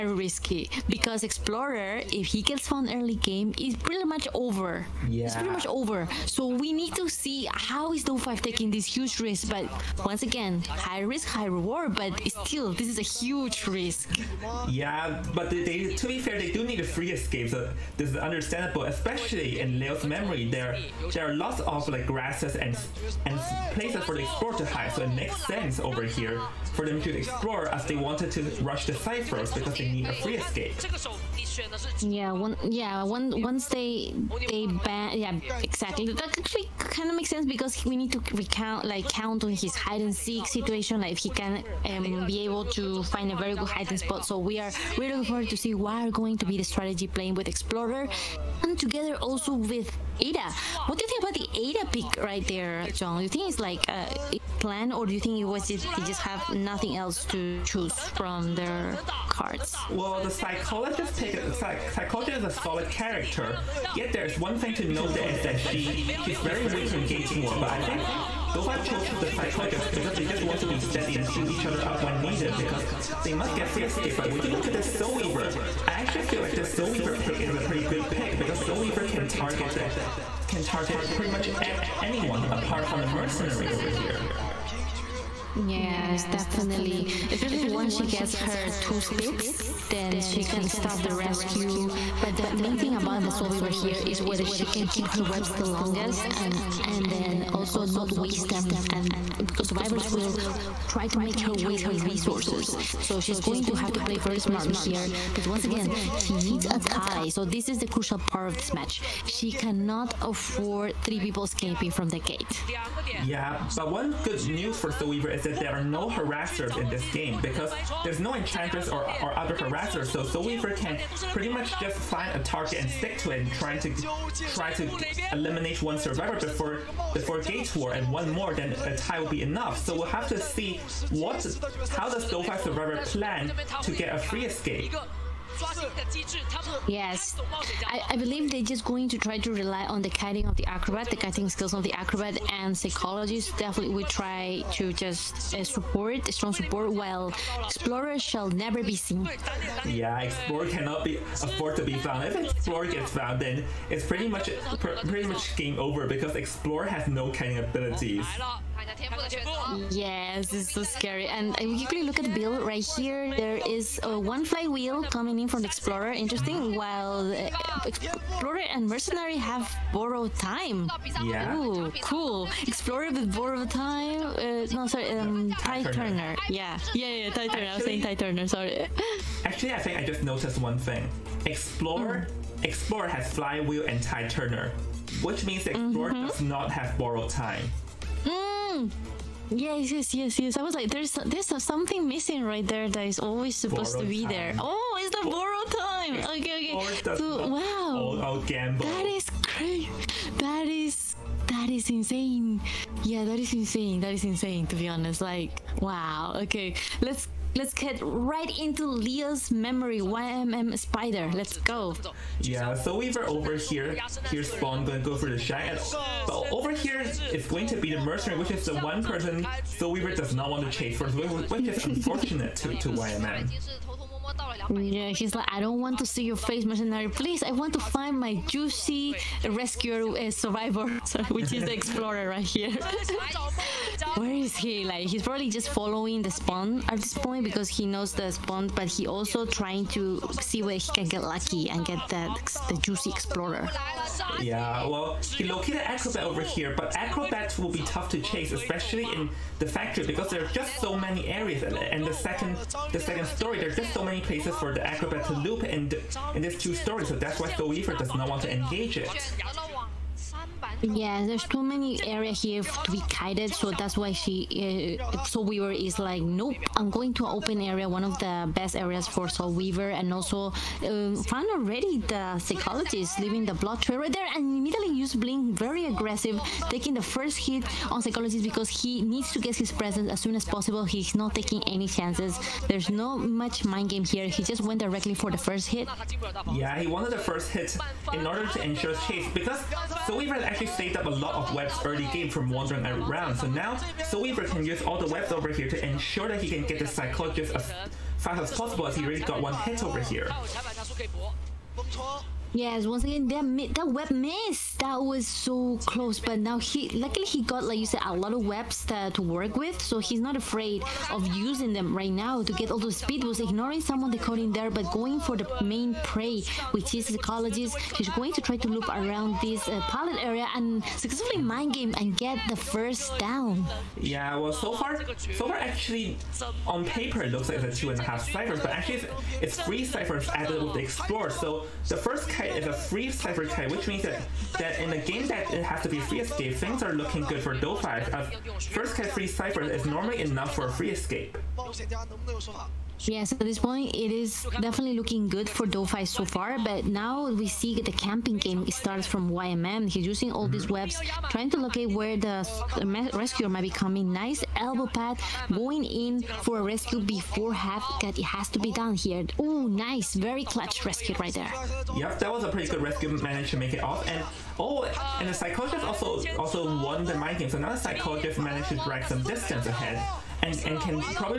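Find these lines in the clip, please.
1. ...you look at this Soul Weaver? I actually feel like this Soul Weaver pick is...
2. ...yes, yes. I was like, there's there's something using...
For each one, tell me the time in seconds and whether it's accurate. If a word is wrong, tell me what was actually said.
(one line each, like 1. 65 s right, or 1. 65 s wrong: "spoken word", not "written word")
1. 74 s right
2. 190 s wrong: "missing", not "using".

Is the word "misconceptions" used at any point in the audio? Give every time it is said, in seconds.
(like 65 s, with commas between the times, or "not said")
not said.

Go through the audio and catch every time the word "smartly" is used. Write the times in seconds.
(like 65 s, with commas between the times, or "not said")
104 s.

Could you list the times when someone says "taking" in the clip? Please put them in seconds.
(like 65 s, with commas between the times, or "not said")
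8 s, 276 s, 281 s.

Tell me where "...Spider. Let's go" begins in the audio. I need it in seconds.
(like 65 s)
210 s.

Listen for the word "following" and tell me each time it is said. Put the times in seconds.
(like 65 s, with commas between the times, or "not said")
235 s.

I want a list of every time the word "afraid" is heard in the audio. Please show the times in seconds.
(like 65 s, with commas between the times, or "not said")
310 s.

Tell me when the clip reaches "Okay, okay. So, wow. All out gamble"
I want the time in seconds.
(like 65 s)
196 s.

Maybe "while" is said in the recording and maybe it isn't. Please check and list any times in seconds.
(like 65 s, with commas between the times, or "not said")
146 s, 166 s.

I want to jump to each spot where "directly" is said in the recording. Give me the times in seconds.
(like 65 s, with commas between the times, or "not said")
284 s.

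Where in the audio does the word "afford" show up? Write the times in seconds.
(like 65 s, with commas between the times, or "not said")
110 s, 151 s.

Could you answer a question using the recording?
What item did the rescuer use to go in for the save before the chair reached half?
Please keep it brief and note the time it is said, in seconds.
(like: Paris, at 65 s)
elbow pad, at 354 s.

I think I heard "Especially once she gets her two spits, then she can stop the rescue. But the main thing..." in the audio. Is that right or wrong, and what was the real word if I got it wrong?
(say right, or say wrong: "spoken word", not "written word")
right.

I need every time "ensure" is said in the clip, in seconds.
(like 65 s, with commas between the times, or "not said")
288 s, 295 s.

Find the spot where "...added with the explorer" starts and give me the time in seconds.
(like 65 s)
330 s.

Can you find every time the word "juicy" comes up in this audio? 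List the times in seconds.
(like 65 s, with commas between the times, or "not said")
228 s, 242 s.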